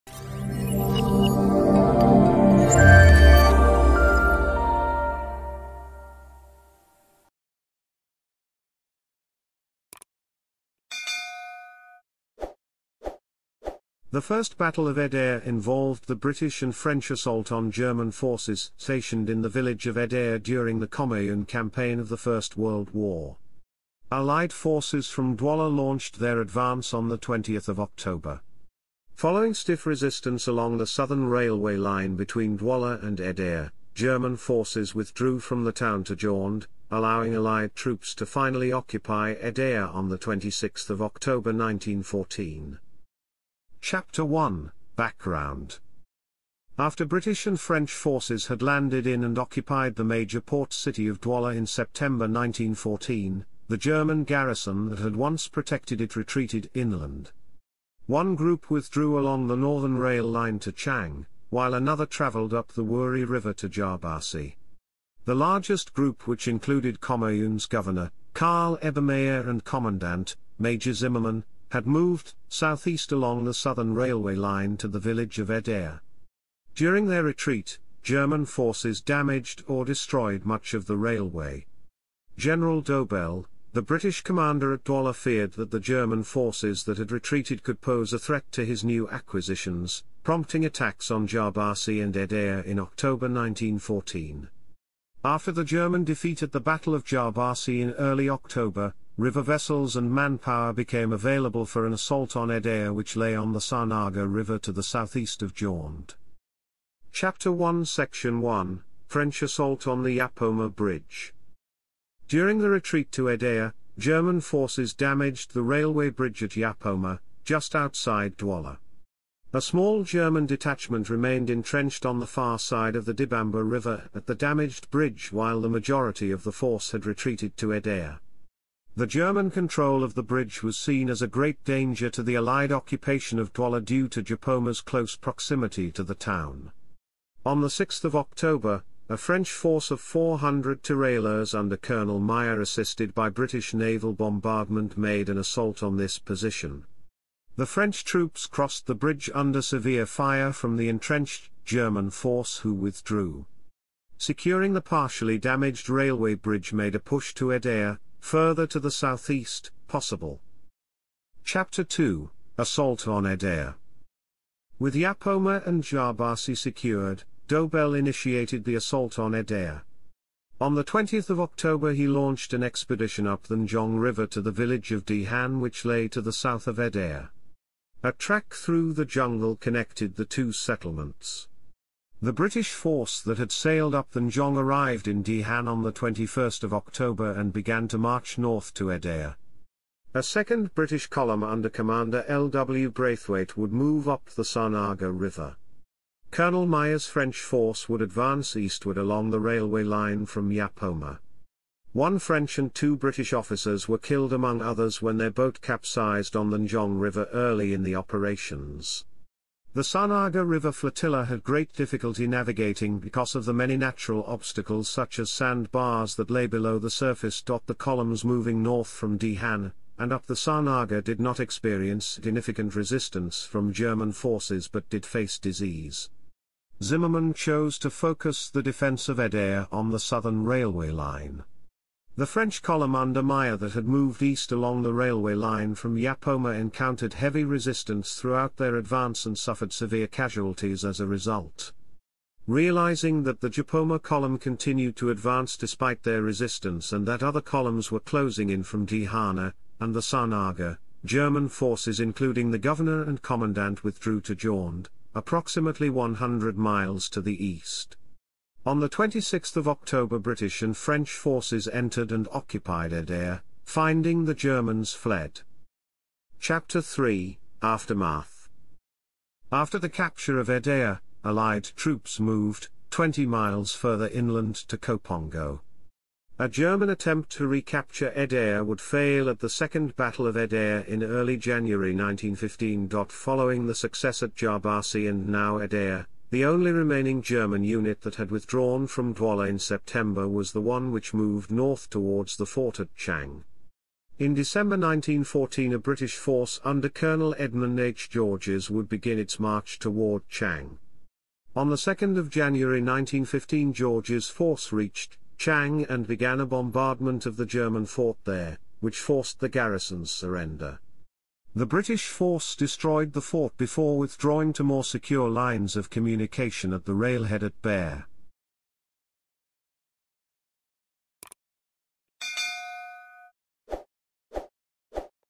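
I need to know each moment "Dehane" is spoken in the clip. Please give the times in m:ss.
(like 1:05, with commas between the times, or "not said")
2:55, 3:05, 3:39, 4:08.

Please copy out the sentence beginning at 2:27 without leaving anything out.
The French troops crossed the bridge under severe fire from the entrenched German force who withdrew.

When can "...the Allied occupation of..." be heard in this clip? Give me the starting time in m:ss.
2:12.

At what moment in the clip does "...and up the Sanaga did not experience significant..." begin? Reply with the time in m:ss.
3:39.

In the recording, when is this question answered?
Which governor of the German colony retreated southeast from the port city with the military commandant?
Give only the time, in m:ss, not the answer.
1:08.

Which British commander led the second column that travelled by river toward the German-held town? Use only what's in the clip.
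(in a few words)
L. W. Braithwaite.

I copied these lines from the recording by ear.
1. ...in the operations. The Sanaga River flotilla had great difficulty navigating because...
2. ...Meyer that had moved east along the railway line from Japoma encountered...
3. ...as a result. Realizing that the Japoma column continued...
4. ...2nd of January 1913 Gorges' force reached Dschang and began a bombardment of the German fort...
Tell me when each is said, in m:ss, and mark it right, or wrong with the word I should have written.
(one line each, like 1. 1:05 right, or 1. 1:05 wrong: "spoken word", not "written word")
1. 3:27 right
2. 3:53 right
3. 4:00 right
4. 5:01 wrong: "1915", not "1913".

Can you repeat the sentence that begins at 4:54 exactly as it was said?
In December 1914 a British force under Colonel Edmund H.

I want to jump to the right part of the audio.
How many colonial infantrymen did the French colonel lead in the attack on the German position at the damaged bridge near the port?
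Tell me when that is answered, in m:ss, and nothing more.
2:20.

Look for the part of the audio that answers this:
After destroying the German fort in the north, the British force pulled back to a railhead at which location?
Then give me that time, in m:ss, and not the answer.
5:17.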